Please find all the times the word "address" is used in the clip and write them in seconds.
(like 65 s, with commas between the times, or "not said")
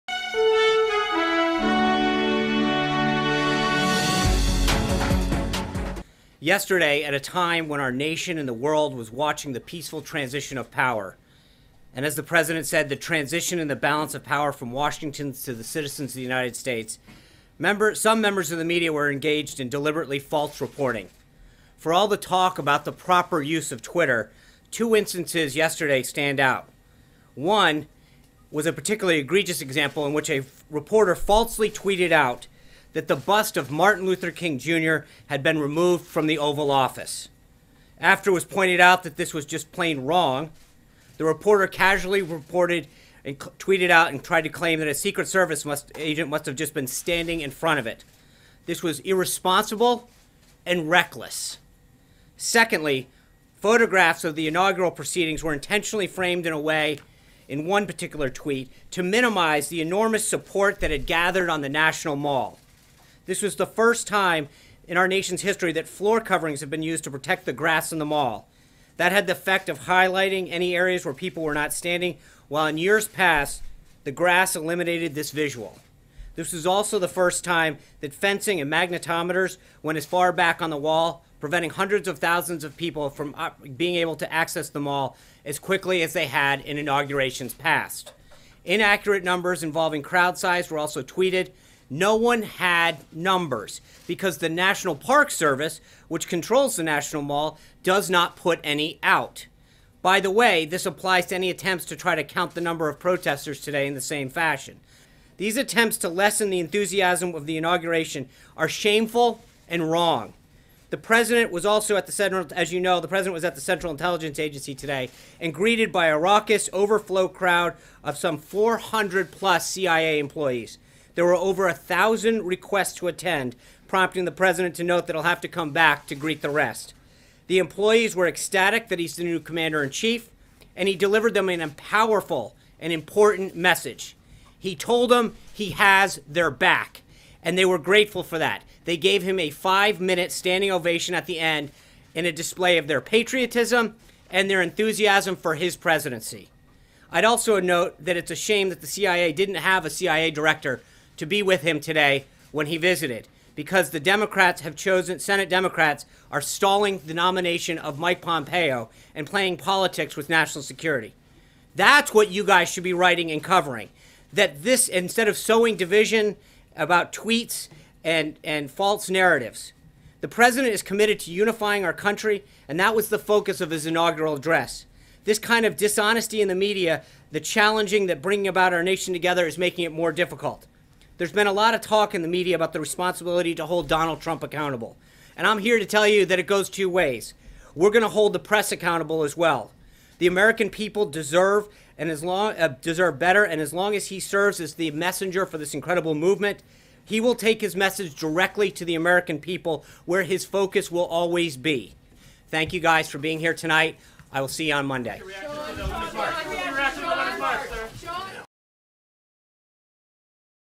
174 s.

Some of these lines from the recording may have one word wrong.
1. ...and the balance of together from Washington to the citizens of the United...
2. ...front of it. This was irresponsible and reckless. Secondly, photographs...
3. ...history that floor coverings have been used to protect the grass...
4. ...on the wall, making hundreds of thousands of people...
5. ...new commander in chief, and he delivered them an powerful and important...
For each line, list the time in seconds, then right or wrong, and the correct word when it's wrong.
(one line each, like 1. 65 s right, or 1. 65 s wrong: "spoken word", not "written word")
1. 13 s wrong: "power", not "together"
2. 47 s right
3. 65 s right
4. 80 s wrong: "preventing", not "making"
5. 129 s right.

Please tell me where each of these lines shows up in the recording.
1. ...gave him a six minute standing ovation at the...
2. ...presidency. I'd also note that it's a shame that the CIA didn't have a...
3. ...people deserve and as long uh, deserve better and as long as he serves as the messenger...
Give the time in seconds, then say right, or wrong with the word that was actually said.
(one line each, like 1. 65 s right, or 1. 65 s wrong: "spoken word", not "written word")
1. 138 s wrong: "five", not "six"
2. 145 s right
3. 190 s right.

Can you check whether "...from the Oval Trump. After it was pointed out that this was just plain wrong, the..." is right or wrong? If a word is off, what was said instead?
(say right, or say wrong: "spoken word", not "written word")
wrong: "Office", not "Trump".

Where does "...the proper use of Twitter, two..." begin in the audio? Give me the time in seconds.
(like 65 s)
22 s.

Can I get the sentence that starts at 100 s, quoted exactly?
By the way, this applies to any attempts to try to count the number of protesters today in the same fashion.